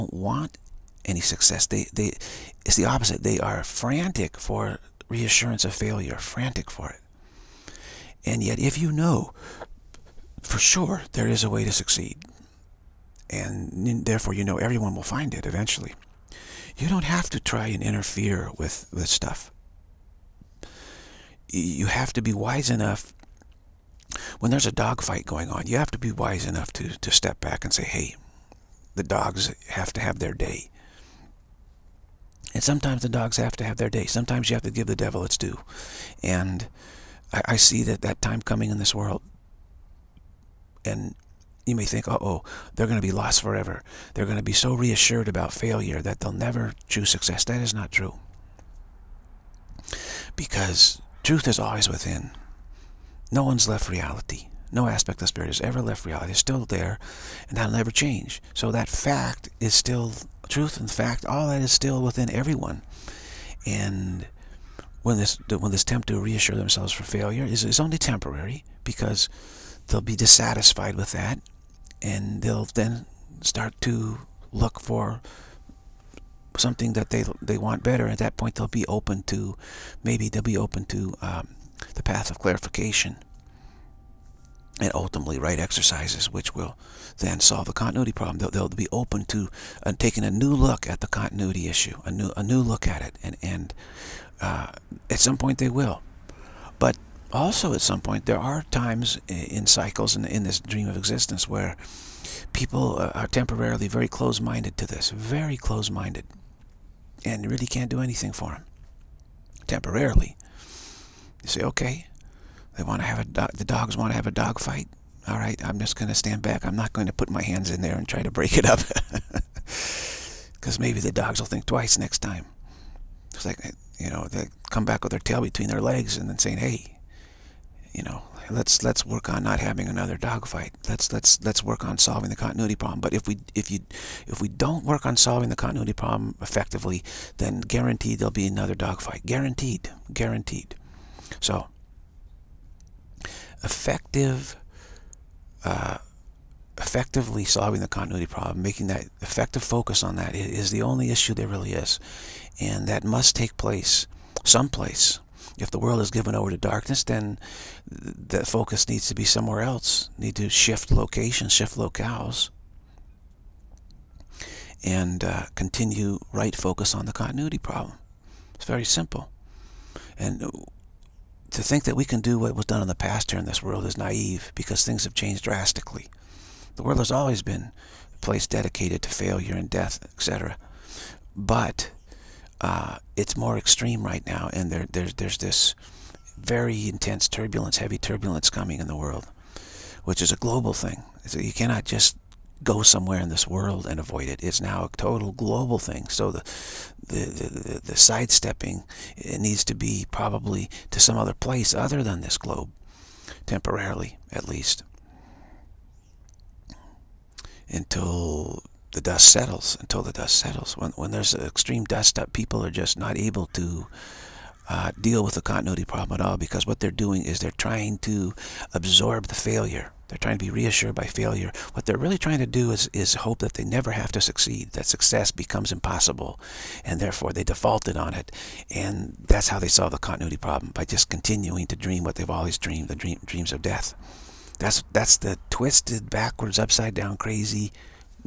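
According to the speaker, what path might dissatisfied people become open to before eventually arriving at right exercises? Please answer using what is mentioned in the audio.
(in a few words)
the path of clarification.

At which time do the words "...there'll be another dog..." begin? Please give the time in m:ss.
2:18.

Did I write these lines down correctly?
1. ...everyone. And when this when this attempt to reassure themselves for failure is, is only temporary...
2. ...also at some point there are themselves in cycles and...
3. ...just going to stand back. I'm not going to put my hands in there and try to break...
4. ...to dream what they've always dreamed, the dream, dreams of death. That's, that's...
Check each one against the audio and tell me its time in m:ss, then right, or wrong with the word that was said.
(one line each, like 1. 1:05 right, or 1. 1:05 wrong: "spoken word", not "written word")
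1. 1:02 right
2. 1:37 wrong: "times", not "themselves"
3. 1:55 right
4. 3:51 right.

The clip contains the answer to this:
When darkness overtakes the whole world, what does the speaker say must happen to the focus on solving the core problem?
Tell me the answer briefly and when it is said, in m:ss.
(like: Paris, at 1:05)
shift locales, at 2:41.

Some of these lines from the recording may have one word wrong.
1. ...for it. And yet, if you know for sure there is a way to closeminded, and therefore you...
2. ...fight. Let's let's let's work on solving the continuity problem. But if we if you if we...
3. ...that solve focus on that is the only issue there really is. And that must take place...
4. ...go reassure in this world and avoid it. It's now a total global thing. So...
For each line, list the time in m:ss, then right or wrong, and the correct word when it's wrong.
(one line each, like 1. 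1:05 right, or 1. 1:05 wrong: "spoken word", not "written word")
1. 0:06 wrong: "succeed", not "closeminded"
2. 2:10 right
3. 2:28 wrong: "effective", not "solve"
4. 3:12 wrong: "somewhere", not "reassure".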